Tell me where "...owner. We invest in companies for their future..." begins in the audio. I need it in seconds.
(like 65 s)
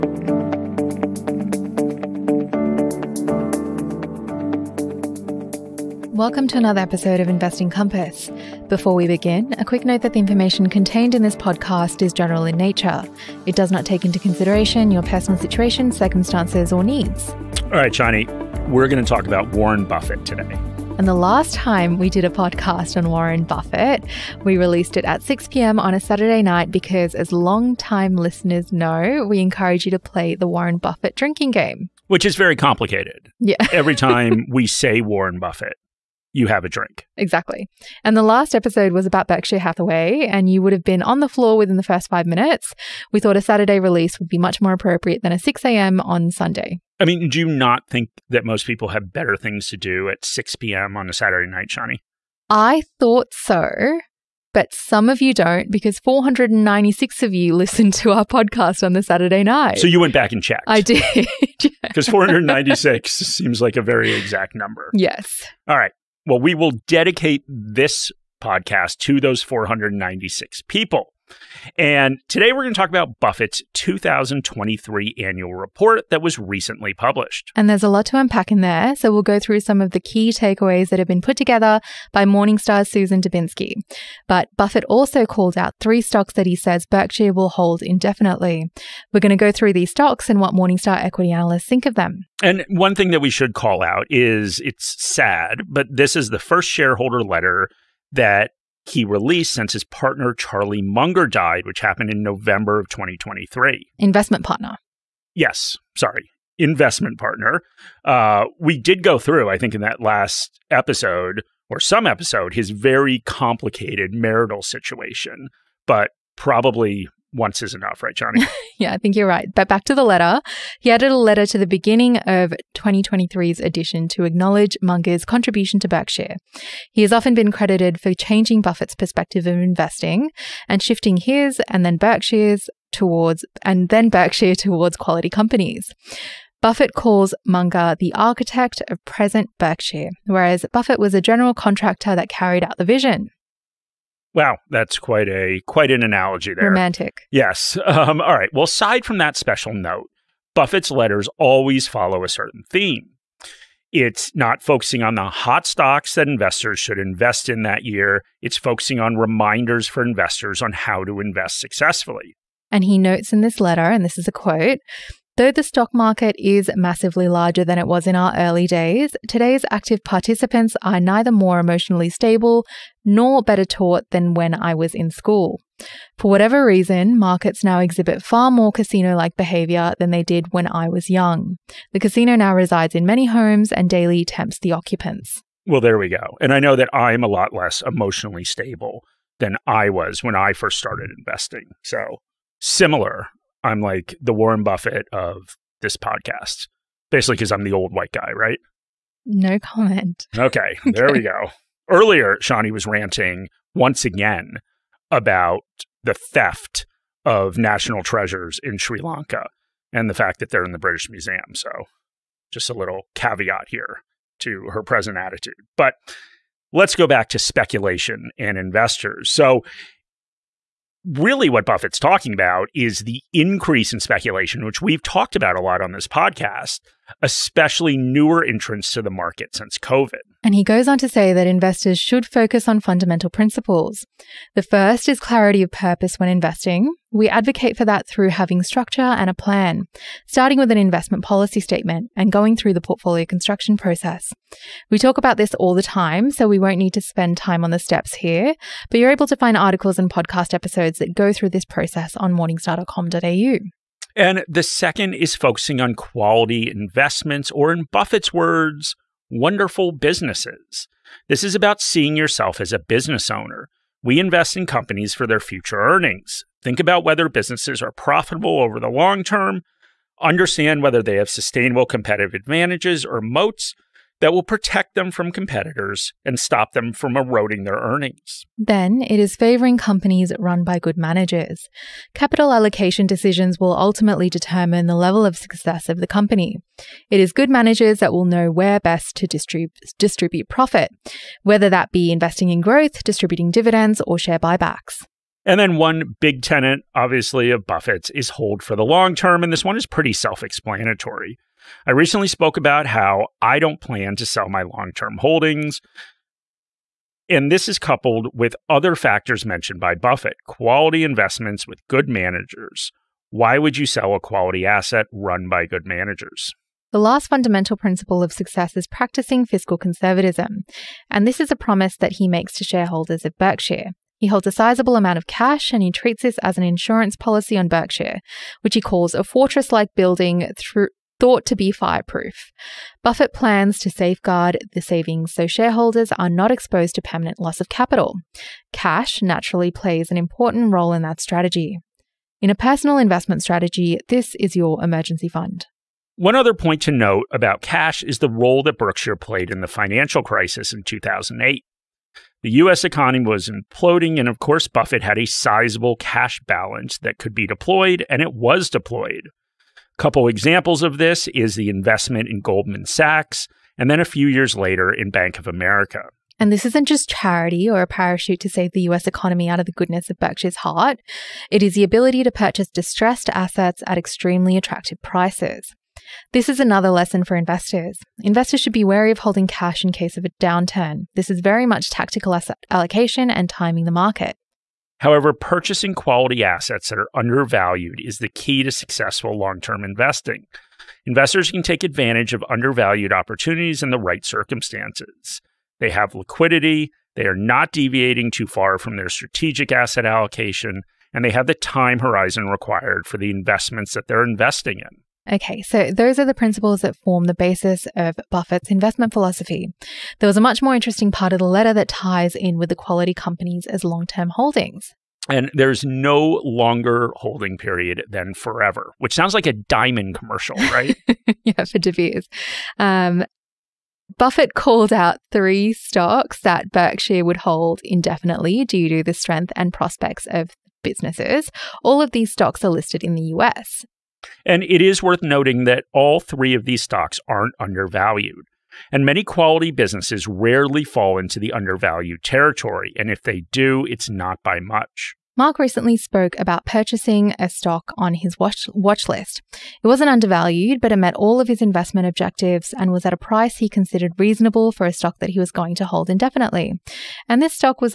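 263 s.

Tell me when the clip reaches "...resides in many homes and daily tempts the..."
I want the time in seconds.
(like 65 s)
182 s.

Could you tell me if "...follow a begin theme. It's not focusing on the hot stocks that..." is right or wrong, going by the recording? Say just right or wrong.
wrong.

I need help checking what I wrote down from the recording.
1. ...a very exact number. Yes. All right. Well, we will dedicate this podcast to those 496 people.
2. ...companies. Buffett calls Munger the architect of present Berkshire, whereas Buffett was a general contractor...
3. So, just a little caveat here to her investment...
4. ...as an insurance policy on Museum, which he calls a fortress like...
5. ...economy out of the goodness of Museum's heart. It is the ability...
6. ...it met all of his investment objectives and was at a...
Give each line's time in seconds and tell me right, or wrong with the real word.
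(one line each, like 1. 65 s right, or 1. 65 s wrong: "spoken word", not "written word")
1. 63 s right
2. 135 s right
3. 211 s wrong: "present", not "investment"
4. 326 s wrong: "Berkshire", not "Museum"
5. 369 s wrong: "Berkshire", not "Museum"
6. 450 s right.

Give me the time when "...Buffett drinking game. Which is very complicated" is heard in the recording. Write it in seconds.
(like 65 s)
30 s.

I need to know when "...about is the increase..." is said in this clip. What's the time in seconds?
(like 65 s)
222 s.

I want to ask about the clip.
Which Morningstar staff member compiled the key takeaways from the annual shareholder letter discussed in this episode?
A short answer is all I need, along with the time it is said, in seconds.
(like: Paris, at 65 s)
Susan Dziubinski, at 82 s.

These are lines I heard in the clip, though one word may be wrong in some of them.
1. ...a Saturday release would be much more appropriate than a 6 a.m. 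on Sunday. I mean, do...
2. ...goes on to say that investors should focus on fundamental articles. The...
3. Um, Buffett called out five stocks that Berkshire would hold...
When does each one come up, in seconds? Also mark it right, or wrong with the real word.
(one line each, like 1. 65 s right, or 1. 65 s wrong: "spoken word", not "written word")
1. 43 s right
2. 230 s wrong: "principles", not "articles"
3. 422 s wrong: "three", not "five".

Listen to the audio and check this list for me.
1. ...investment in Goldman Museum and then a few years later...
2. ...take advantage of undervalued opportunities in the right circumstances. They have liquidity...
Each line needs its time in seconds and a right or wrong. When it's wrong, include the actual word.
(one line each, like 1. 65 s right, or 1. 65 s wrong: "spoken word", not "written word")
1. 361 s wrong: "Sachs", not "Museum"
2. 391 s right.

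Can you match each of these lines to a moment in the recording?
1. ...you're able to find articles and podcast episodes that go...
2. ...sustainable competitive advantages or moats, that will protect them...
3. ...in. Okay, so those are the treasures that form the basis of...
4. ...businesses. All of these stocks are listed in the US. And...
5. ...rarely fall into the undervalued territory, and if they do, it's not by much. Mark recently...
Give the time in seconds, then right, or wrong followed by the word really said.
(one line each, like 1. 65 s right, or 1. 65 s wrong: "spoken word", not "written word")
1. 248 s right
2. 271 s right
3. 404 s wrong: "principles", not "treasures"
4. 430 s right
5. 440 s right.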